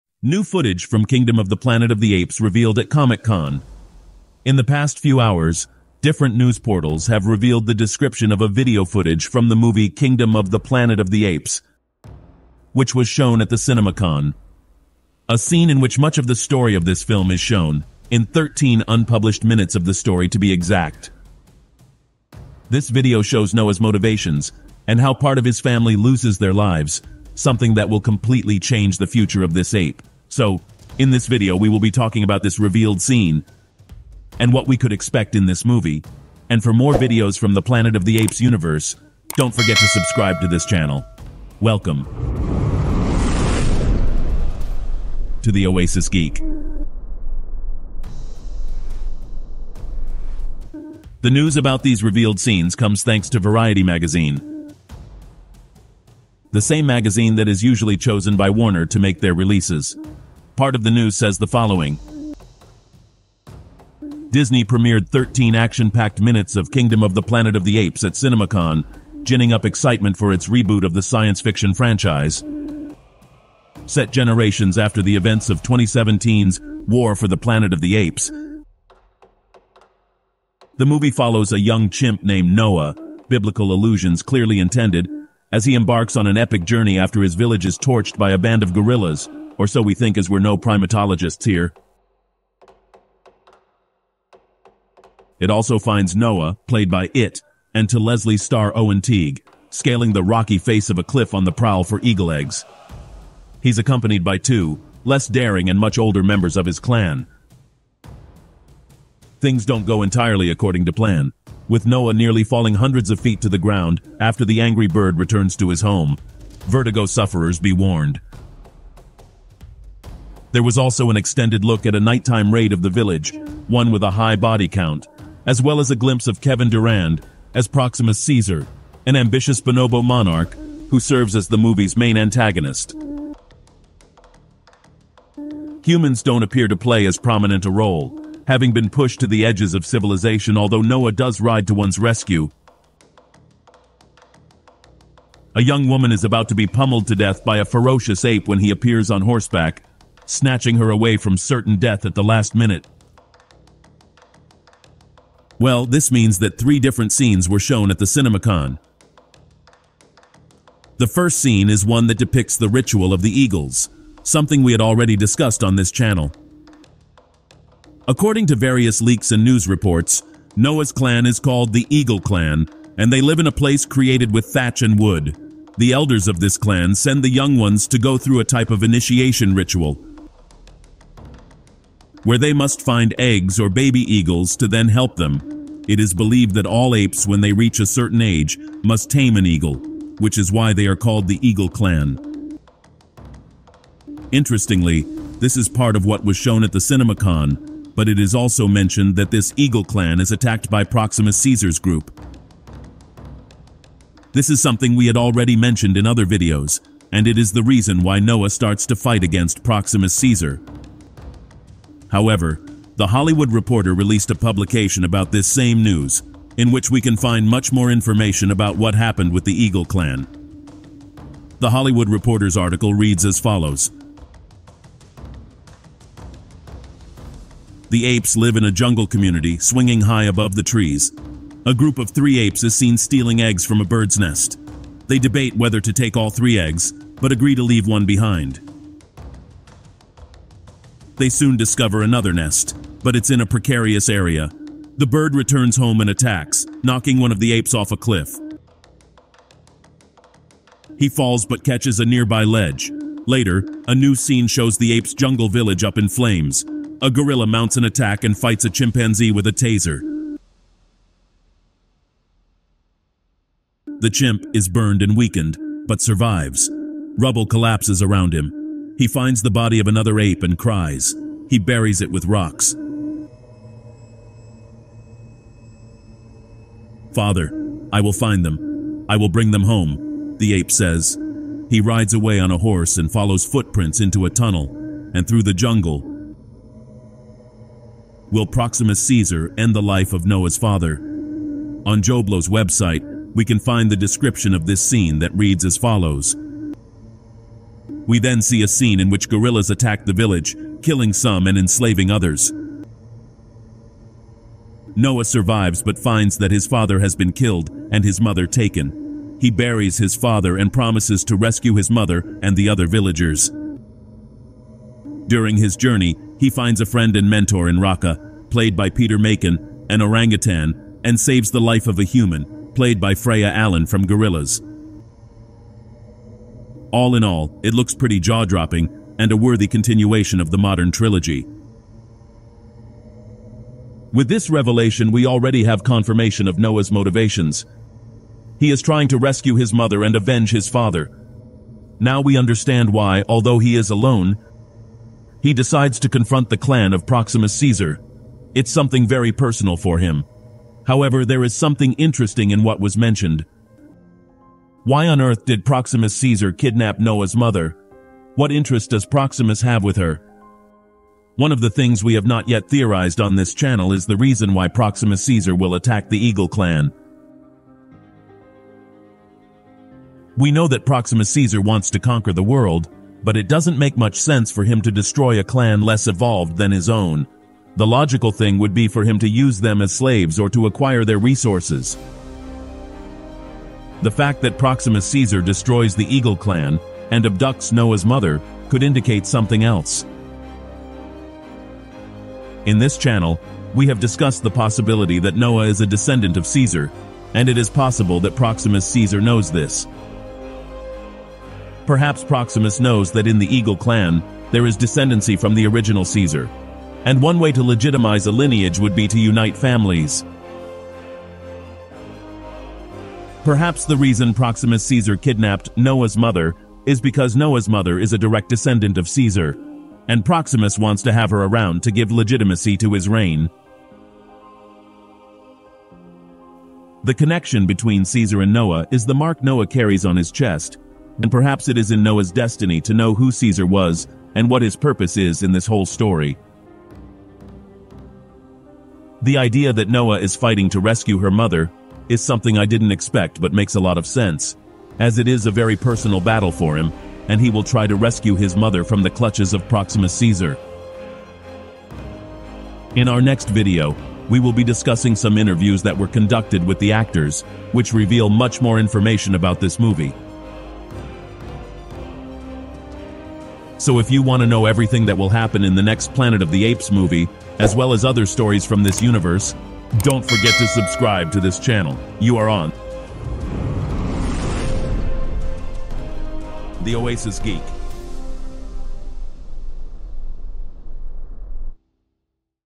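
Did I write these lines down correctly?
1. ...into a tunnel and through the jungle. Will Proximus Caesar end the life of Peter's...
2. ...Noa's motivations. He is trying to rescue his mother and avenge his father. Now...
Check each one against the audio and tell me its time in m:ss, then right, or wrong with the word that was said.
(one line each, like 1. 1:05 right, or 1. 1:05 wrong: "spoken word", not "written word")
1. 4:43 wrong: "Noa", not "Peter"
2. 5:36 right.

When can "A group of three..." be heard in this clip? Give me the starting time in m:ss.
3:51.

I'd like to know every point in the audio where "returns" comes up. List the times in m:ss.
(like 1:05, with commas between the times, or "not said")
1:55, 4:05.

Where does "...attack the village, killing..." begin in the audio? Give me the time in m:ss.
4:59.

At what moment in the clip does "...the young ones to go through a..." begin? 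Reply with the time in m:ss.
2:57.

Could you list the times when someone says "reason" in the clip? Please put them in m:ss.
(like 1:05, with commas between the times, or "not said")
3:27, 6:04, 6:53.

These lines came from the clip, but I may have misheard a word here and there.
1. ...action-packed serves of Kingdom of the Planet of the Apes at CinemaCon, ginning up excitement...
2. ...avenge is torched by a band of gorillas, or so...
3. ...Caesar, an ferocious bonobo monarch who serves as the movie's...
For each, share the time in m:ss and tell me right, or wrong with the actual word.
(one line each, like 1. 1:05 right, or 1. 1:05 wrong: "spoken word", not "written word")
1. 1:05 wrong: "minutes", not "serves"
2. 1:27 wrong: "village", not "avenge"
3. 2:08 wrong: "ambitious", not "ferocious".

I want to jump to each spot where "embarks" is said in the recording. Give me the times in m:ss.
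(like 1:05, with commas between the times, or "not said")
1:25.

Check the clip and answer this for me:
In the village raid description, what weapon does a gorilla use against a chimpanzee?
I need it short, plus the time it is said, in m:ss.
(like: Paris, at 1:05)
taser, at 4:19.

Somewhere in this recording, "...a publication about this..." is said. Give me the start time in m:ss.
3:34.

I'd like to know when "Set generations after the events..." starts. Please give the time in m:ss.
1:13.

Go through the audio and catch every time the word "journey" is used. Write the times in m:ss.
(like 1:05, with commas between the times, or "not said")
1:26, 5:15.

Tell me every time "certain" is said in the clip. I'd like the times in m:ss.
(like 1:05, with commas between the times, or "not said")
2:31, 3:07.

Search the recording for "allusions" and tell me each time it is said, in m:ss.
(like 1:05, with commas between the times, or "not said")
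1:23.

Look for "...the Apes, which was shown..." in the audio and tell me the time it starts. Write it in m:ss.
0:11.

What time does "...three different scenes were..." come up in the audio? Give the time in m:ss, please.
2:36.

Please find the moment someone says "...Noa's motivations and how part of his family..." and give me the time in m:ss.
0:23.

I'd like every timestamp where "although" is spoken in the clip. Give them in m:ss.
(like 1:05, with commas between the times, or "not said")
2:20, 5:43.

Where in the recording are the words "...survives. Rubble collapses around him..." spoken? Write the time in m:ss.
4:26.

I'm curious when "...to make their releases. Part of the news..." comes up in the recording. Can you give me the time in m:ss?
0:58.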